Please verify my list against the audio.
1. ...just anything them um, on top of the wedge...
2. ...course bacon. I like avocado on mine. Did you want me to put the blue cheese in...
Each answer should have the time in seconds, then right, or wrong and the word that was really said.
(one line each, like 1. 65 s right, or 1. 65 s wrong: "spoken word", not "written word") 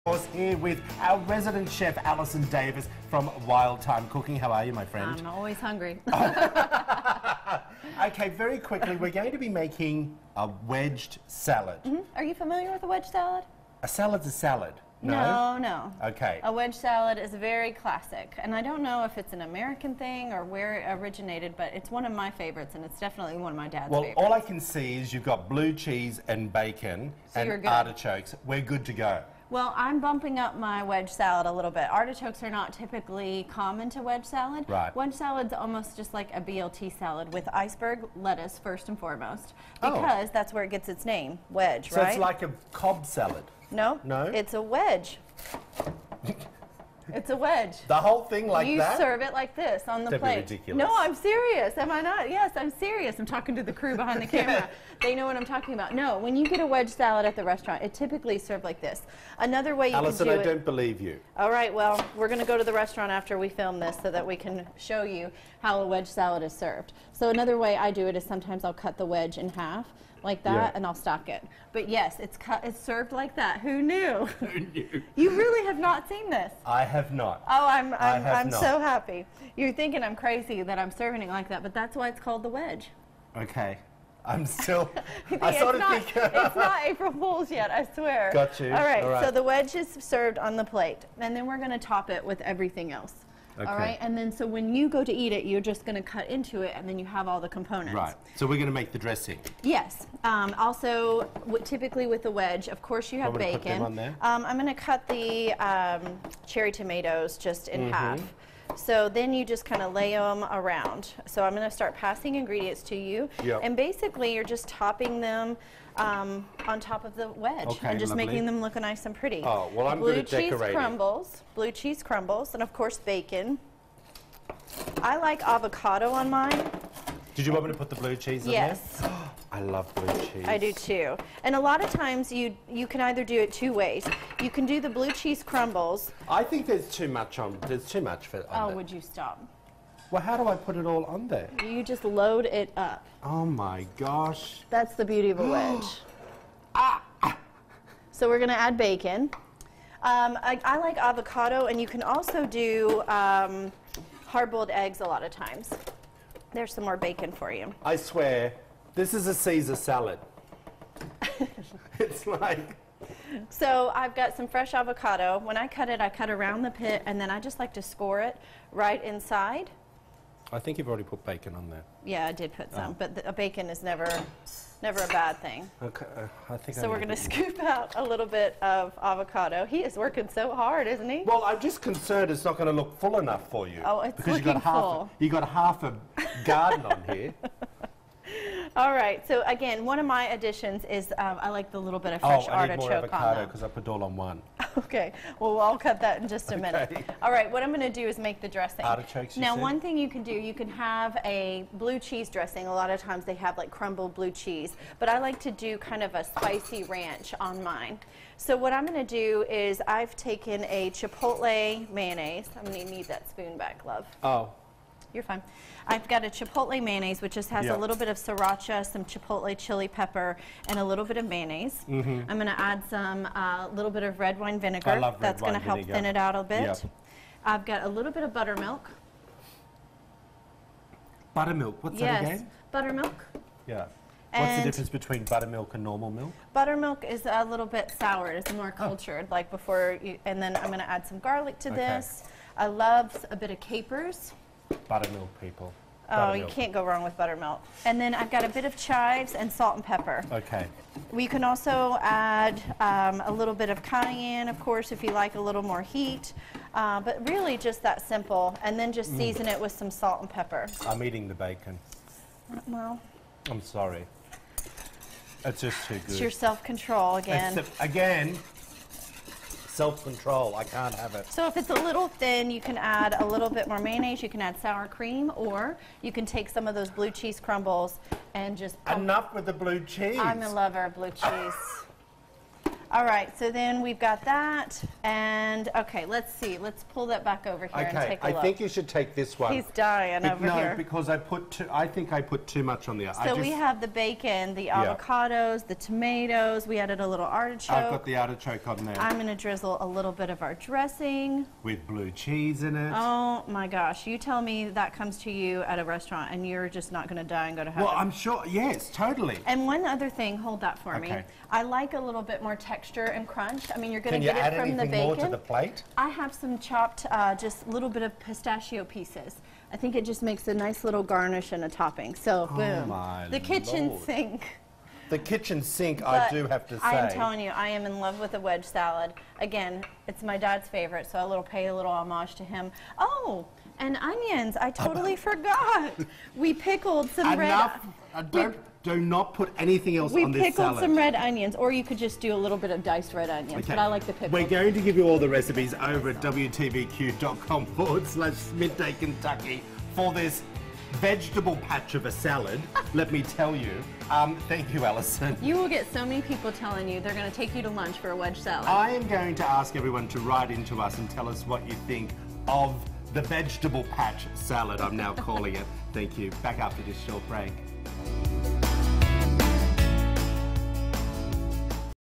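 1. 114 s wrong: "topping", not "anything"
2. 122 s right.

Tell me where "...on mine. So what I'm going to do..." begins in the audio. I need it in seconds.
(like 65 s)
207 s.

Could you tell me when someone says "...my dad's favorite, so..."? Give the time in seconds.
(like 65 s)
330 s.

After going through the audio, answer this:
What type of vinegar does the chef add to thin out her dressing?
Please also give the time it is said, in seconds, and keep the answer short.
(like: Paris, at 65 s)
Red wine vinegar, at 224 s.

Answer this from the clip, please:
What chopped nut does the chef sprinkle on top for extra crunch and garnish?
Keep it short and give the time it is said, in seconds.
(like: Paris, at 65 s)
Pistachio, at 318 s.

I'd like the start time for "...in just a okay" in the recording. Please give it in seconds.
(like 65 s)
196 s.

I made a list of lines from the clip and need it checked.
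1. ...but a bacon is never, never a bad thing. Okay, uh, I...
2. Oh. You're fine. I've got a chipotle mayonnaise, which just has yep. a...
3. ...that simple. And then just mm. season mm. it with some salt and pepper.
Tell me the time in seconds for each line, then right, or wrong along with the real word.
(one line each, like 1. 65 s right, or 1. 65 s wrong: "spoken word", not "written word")
1. 172 s right
2. 214 s right
3. 257 s right.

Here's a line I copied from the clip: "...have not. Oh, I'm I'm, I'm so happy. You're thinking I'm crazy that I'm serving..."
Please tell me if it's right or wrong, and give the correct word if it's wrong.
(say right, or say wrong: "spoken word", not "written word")
right.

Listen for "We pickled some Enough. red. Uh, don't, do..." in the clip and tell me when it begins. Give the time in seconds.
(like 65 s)
336 s.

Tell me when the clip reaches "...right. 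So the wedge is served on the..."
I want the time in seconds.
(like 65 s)
89 s.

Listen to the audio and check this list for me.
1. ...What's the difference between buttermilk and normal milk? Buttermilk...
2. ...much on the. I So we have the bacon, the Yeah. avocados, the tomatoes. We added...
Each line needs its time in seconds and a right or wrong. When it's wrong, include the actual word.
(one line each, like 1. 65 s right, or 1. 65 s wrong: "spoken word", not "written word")
1. 234 s right
2. 292 s right.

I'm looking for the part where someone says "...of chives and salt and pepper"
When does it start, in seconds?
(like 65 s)
248 s.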